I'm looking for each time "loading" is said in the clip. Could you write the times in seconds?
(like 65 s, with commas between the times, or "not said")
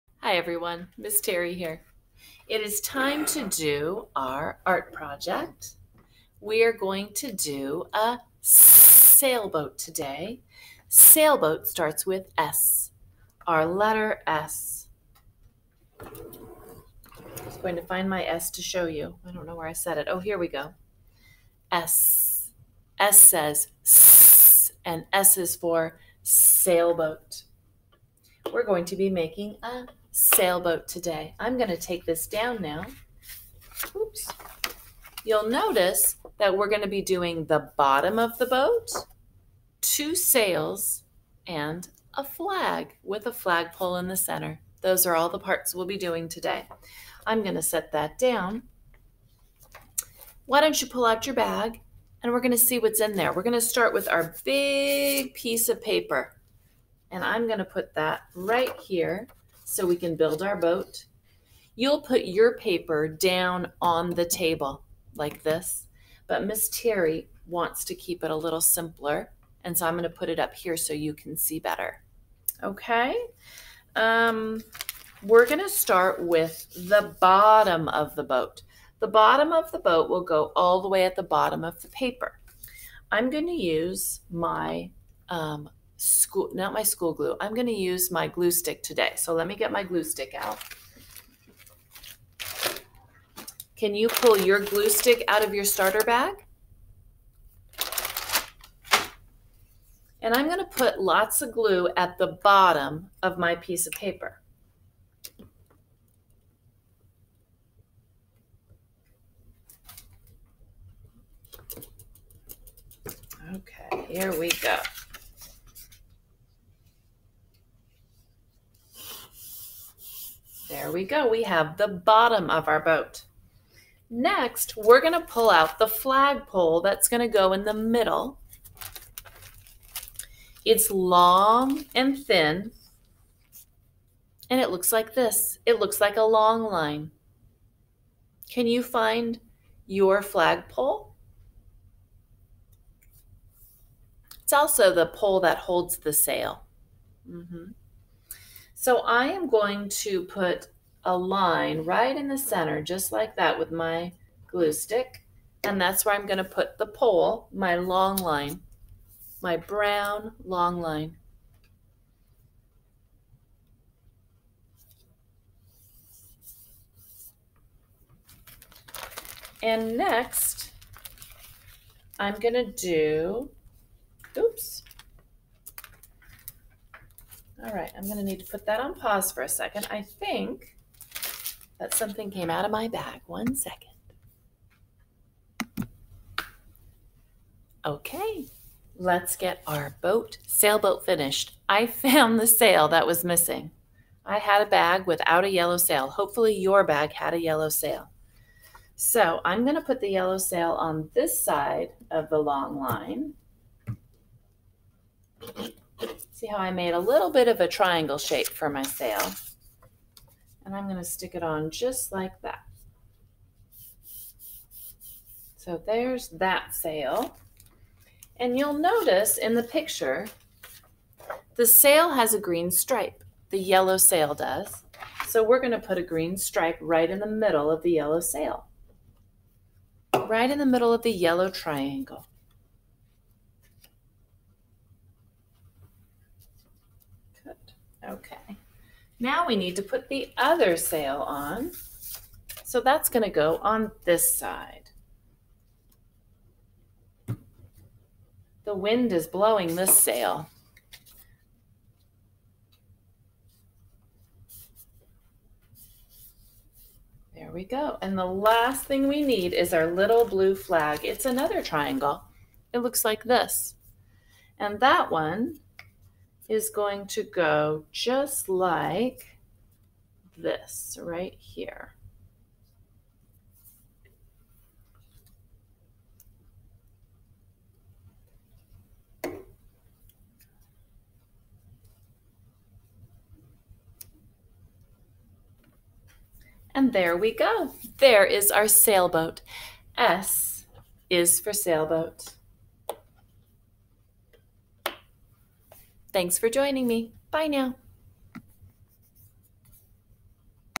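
not said.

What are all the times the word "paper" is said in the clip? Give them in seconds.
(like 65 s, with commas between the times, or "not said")
55 s, 62 s, 81 s, 103 s.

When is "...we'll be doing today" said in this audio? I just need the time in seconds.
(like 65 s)
45 s.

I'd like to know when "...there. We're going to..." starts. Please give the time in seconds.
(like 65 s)
53 s.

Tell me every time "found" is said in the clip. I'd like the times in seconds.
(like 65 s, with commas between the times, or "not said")
191 s.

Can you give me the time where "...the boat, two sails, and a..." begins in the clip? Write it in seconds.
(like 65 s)
38 s.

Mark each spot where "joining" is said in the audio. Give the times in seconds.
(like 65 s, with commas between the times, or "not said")
296 s.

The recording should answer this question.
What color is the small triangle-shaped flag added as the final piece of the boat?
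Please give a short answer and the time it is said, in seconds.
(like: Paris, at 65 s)
blue, at 260 s.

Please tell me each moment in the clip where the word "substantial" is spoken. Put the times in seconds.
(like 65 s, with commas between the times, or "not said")
not said.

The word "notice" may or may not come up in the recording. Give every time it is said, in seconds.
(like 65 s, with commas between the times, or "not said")
35 s, 218 s.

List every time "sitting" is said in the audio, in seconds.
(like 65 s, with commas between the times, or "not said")
not said.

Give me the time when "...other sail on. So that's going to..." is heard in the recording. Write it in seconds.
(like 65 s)
240 s.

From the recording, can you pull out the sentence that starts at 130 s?
It's long and thin, and it looks like this.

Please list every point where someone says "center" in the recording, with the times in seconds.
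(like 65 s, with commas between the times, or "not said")
44 s, 152 s.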